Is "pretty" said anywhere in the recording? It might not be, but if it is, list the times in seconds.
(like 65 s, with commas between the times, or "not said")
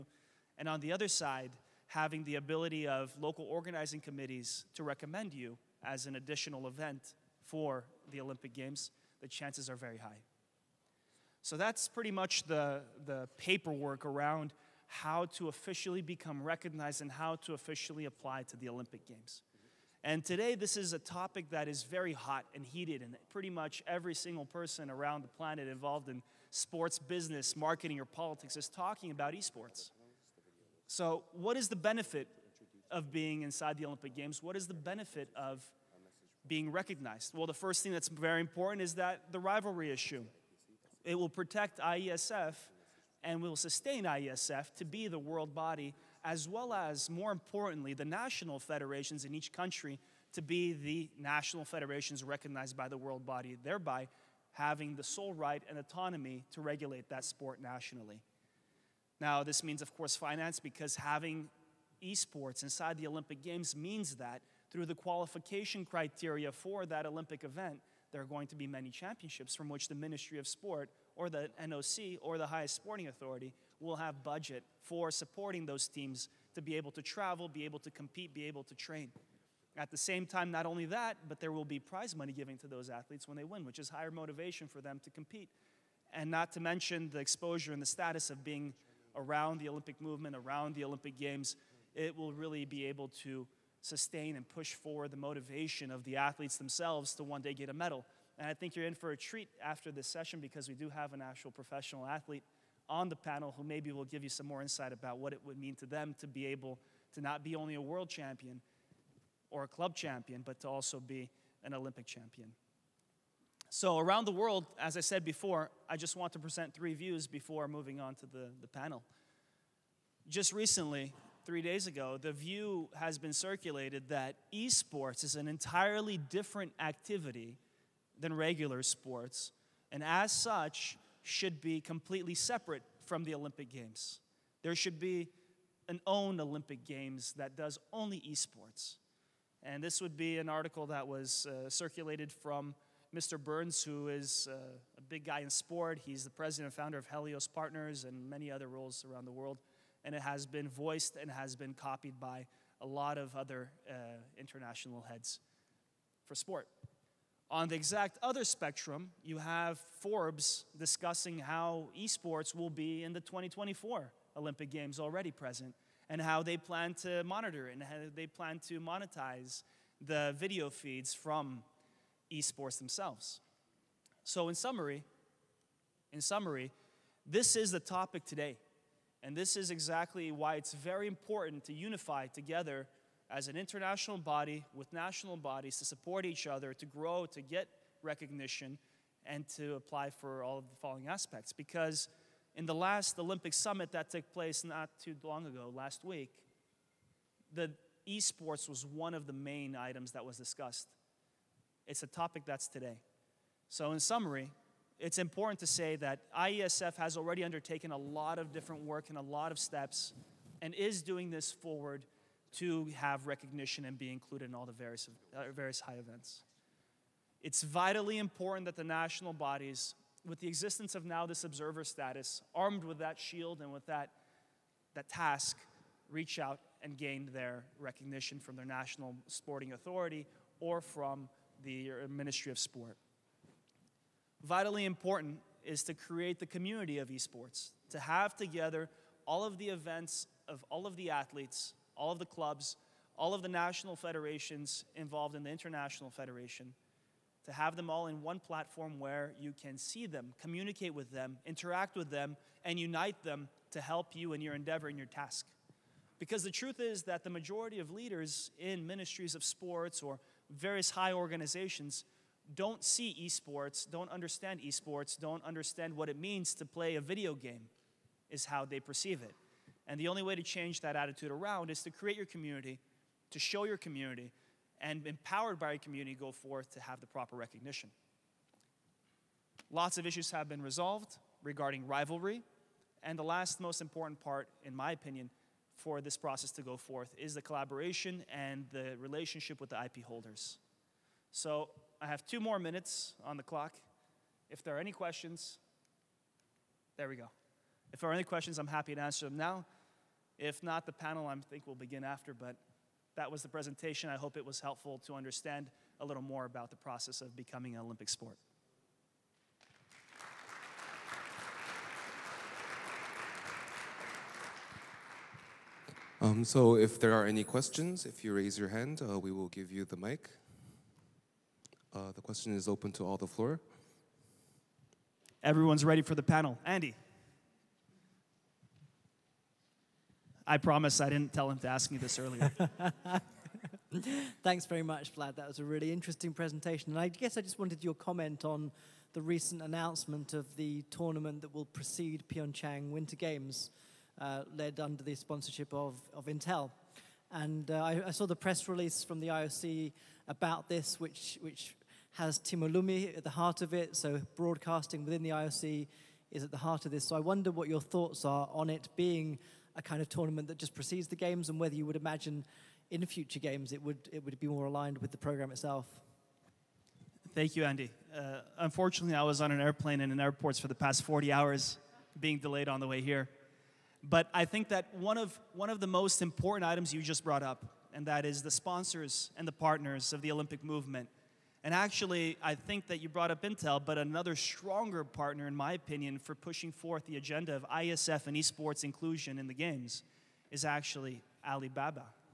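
11 s, 23 s.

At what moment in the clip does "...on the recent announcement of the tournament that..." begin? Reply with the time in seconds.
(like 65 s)
338 s.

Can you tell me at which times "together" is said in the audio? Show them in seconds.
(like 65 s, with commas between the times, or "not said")
182 s, 238 s.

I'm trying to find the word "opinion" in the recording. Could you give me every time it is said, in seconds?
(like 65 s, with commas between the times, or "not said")
284 s, 385 s.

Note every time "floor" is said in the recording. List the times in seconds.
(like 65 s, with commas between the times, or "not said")
323 s.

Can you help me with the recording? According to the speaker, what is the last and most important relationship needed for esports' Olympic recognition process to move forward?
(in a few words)
IP holders.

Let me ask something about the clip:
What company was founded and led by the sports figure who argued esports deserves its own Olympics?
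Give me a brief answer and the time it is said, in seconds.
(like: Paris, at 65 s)
Helios Partners, at 147 s.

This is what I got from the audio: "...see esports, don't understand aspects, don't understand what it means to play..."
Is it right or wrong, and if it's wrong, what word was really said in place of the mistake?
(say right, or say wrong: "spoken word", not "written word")
wrong: "esports", not "aspects".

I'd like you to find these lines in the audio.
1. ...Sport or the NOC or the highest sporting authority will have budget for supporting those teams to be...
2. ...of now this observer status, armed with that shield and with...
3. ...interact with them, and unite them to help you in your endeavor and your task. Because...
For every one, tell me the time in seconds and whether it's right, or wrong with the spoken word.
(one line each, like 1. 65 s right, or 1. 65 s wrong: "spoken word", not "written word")
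1. 70 s right
2. 220 s right
3. 251 s right.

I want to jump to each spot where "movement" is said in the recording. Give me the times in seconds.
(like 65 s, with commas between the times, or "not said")
90 s, 380 s.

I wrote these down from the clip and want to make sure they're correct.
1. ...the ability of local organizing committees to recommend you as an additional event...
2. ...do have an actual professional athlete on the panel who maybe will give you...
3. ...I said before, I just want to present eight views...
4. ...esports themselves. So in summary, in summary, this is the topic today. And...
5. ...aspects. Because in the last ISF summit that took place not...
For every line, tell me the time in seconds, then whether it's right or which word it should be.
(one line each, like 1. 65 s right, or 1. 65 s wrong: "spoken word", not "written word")
1. 2 s right
2. 100 s right
3. 114 s wrong: "three", not "eight"
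4. 172 s right
5. 191 s wrong: "Olympic", not "ISF".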